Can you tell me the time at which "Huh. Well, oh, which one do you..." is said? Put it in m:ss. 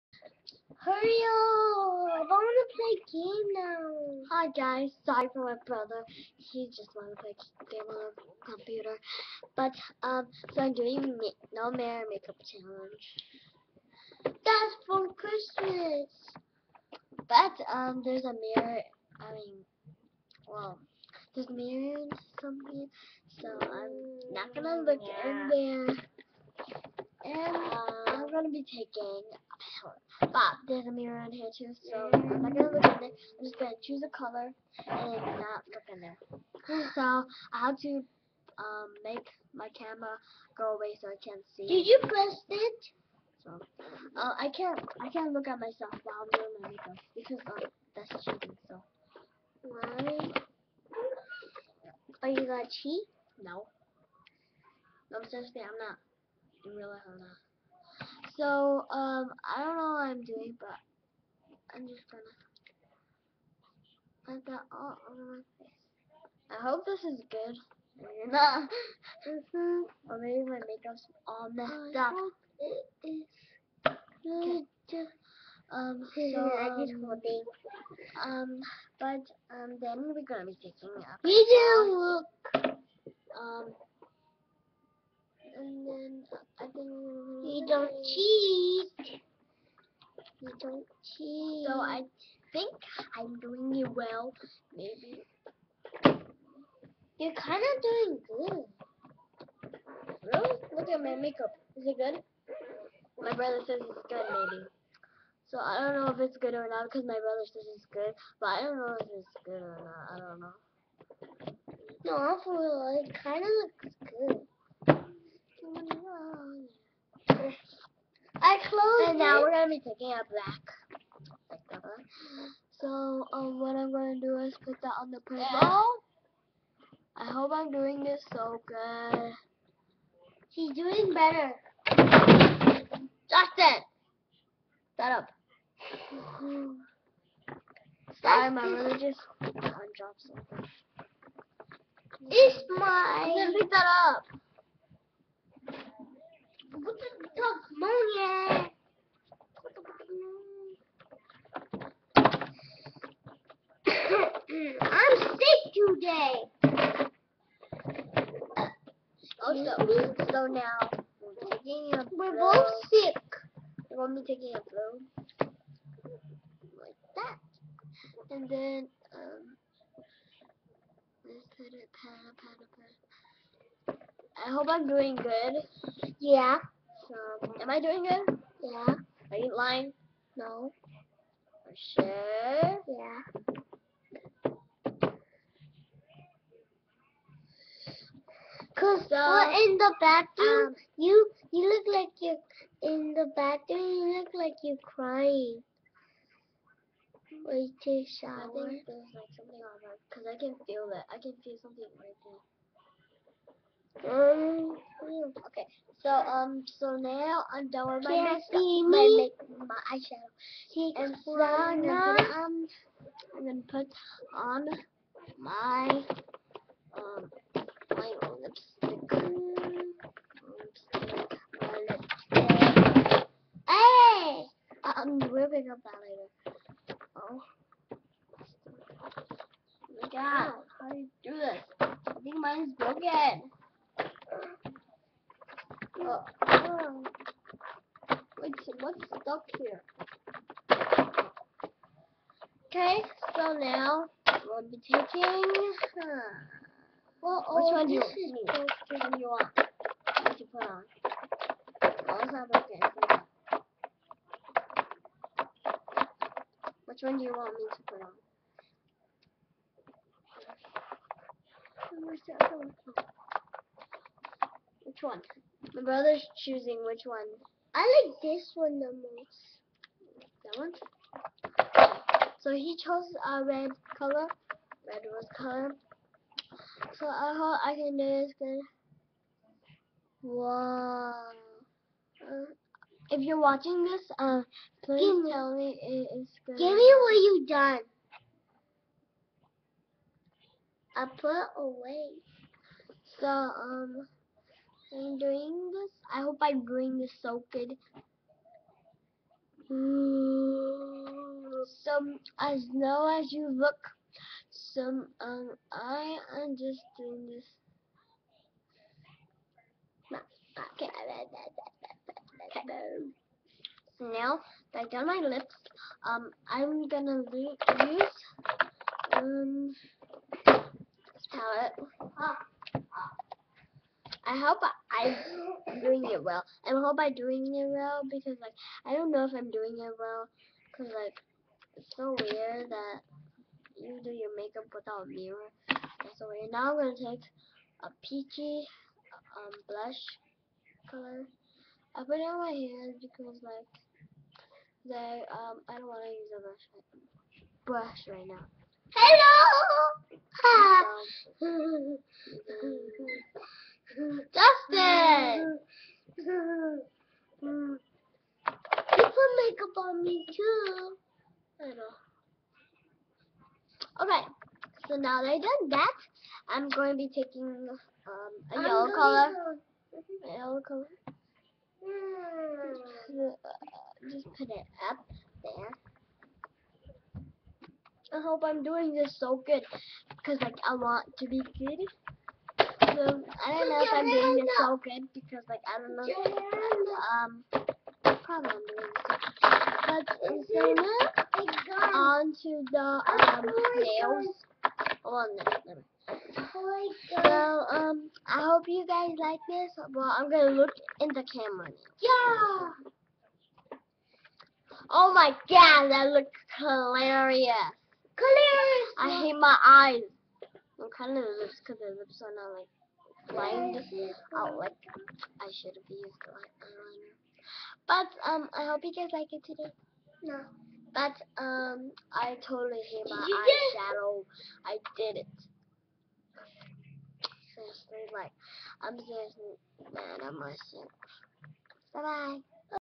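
4:05.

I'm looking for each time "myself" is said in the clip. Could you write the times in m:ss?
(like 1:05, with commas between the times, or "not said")
0:45, 7:10.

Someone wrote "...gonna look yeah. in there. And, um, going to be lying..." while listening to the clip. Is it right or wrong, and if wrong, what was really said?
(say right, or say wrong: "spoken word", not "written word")
wrong: "taking", not "lying".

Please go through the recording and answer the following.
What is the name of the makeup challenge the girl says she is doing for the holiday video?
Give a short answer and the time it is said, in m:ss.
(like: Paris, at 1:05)
No Mirror Makeup Challenge, at 0:11.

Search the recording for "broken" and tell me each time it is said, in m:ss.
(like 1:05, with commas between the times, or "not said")
3:52, 4:12.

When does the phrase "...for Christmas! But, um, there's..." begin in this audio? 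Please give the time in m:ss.
0:14.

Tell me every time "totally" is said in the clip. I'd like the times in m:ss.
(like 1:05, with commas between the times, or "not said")
7:02.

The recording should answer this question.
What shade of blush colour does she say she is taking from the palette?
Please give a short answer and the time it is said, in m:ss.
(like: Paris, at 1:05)
peachy, at 5:38.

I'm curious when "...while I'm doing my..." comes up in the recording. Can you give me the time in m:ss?
0:46.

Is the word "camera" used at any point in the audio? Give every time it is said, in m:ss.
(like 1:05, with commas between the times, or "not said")
0:39, 6:41.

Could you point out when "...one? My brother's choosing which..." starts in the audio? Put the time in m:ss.
4:25.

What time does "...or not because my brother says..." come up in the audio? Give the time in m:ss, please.
1:46.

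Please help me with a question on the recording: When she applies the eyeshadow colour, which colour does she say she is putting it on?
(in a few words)
purple.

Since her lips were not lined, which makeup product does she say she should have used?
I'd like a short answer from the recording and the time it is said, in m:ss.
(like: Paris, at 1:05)
eyeliner, at 6:56.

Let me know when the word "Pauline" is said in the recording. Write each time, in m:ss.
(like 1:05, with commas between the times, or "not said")
not said.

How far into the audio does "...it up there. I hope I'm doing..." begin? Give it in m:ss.
6:14.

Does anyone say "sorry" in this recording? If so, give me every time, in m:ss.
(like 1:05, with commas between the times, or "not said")
0:05, 2:18.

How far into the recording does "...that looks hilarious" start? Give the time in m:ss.
6:45.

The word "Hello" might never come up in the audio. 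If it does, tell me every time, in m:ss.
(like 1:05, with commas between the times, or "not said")
5:48.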